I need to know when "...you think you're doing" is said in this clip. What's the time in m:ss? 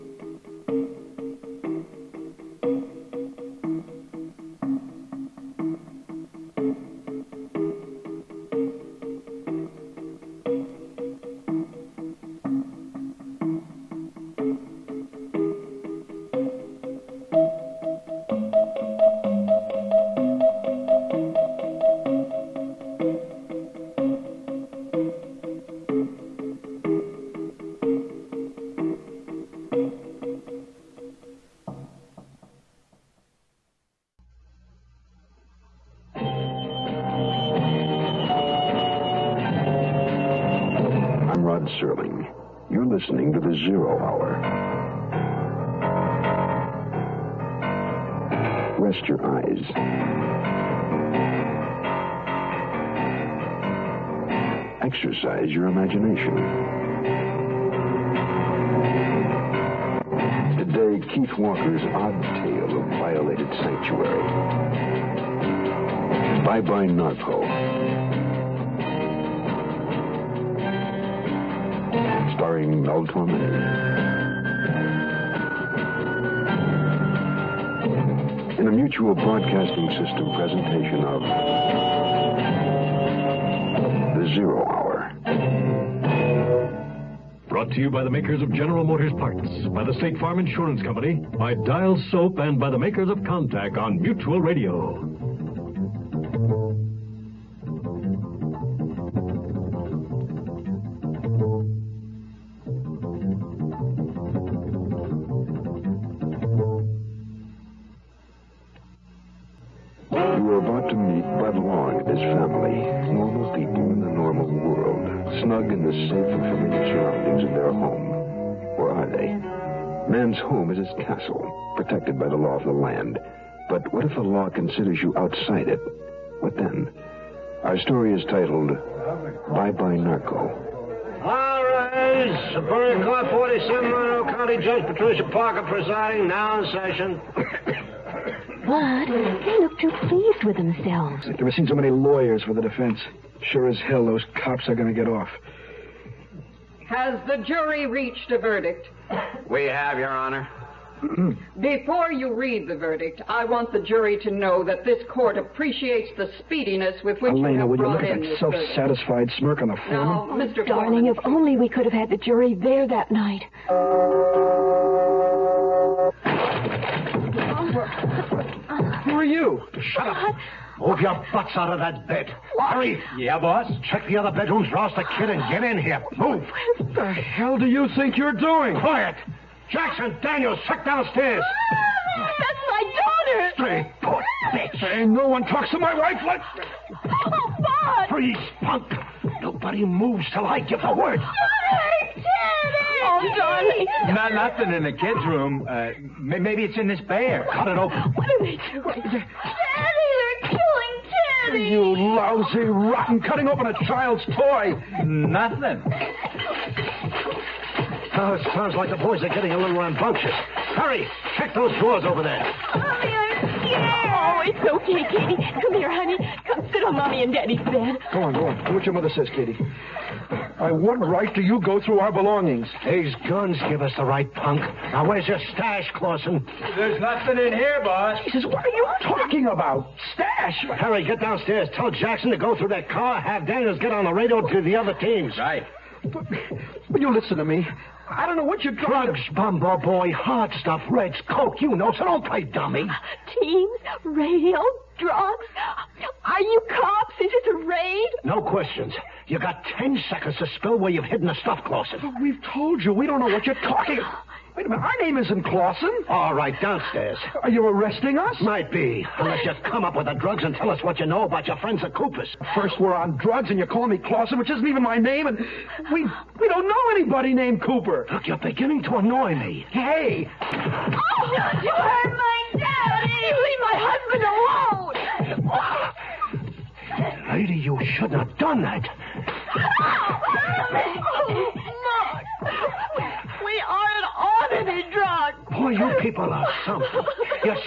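2:57.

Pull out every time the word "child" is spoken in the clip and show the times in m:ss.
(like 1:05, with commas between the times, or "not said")
3:23.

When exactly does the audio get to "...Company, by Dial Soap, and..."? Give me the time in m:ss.
1:30.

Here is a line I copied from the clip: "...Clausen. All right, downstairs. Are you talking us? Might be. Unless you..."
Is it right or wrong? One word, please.
wrong.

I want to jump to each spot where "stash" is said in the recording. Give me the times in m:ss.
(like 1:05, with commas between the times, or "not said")
3:45, 3:50.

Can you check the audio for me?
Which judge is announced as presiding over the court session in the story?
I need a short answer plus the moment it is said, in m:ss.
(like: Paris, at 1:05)
Patricia Parker, at 2:14.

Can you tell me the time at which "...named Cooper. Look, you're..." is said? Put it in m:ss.
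4:27.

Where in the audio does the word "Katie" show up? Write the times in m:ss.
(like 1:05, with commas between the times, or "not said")
3:35, 3:39.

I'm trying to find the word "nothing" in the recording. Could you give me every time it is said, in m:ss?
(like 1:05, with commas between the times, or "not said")
3:14, 3:25, 3:46.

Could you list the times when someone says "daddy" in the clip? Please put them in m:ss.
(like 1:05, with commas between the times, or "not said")
3:11, 3:19, 3:37, 4:32.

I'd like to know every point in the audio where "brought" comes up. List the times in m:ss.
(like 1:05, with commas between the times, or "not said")
1:27, 2:37.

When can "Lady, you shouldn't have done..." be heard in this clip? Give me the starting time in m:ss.
4:37.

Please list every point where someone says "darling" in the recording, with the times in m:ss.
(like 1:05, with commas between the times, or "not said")
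2:40, 3:13.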